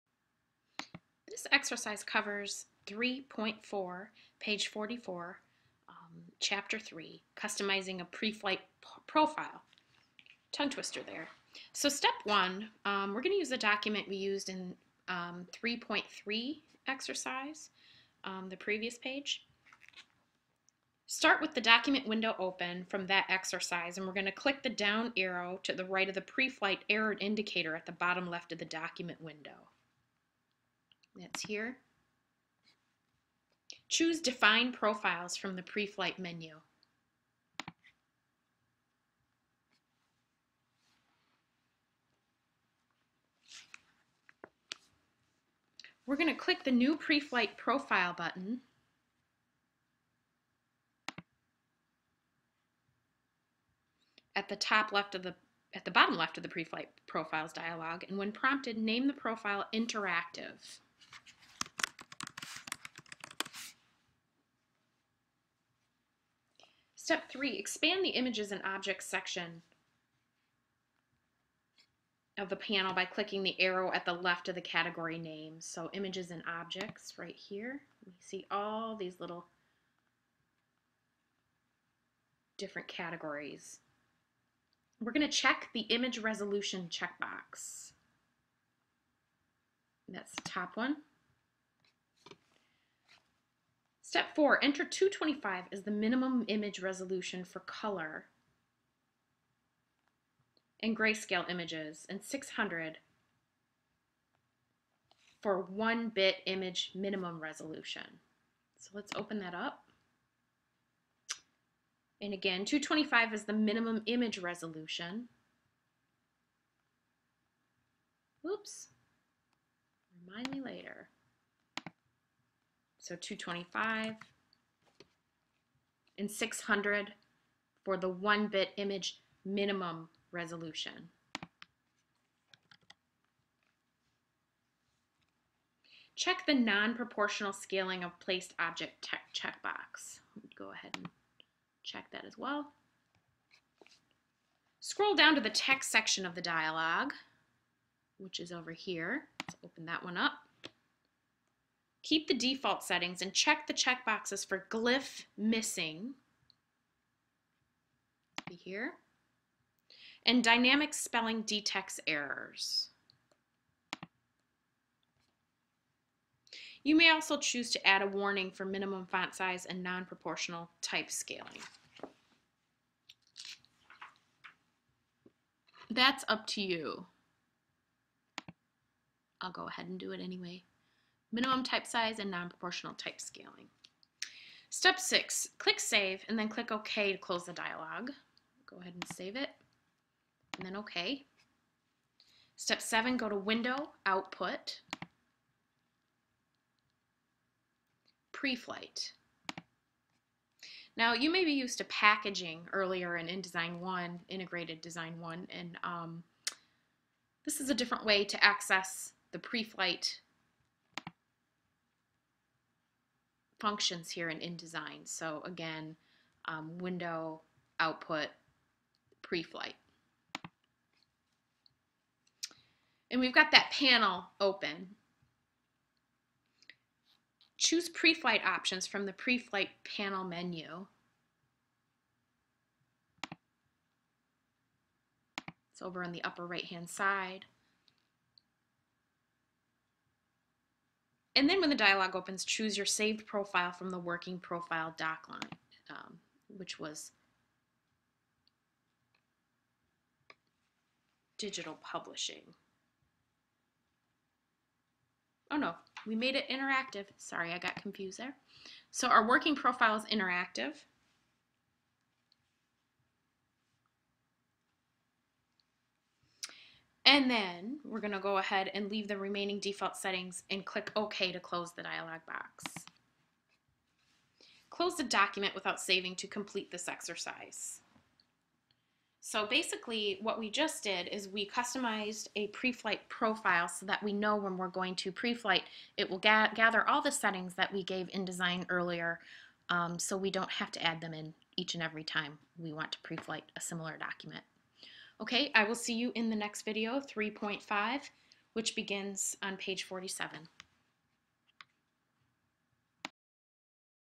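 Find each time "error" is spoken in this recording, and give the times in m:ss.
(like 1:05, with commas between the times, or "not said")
0:26, 2:42.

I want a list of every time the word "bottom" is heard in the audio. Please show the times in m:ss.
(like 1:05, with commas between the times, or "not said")
0:27, 0:55.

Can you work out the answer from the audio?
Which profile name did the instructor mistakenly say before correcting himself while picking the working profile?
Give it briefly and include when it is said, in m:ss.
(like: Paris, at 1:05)
Digital publishing, at 4:11.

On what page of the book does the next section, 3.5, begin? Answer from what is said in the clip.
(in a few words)
47.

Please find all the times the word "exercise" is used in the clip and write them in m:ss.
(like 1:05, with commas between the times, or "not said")
0:01, 0:16, 0:23, 4:36.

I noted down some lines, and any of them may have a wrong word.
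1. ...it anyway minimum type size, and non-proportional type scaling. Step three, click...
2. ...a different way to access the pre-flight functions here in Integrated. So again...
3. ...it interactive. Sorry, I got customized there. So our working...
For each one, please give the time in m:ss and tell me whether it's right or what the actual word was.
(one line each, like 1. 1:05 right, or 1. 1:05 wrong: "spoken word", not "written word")
1. 3:00 wrong: "six", not "three"
2. 3:27 wrong: "InDesign", not "Integrated"
3. 4:16 wrong: "confused", not "customized".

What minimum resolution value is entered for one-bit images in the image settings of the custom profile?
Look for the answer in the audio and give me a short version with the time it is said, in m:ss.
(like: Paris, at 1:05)
600, at 1:42.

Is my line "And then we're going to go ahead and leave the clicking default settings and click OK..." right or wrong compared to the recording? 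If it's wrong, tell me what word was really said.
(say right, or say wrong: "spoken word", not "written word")
wrong: "remaining", not "clicking".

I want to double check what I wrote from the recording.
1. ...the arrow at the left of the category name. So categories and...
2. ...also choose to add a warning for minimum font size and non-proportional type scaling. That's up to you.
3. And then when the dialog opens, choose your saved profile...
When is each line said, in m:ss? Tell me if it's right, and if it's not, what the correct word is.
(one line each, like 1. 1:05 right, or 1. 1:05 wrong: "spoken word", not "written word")
1. 1:13 wrong: "images", not "categories"
2. 2:47 right
3. 4:01 right.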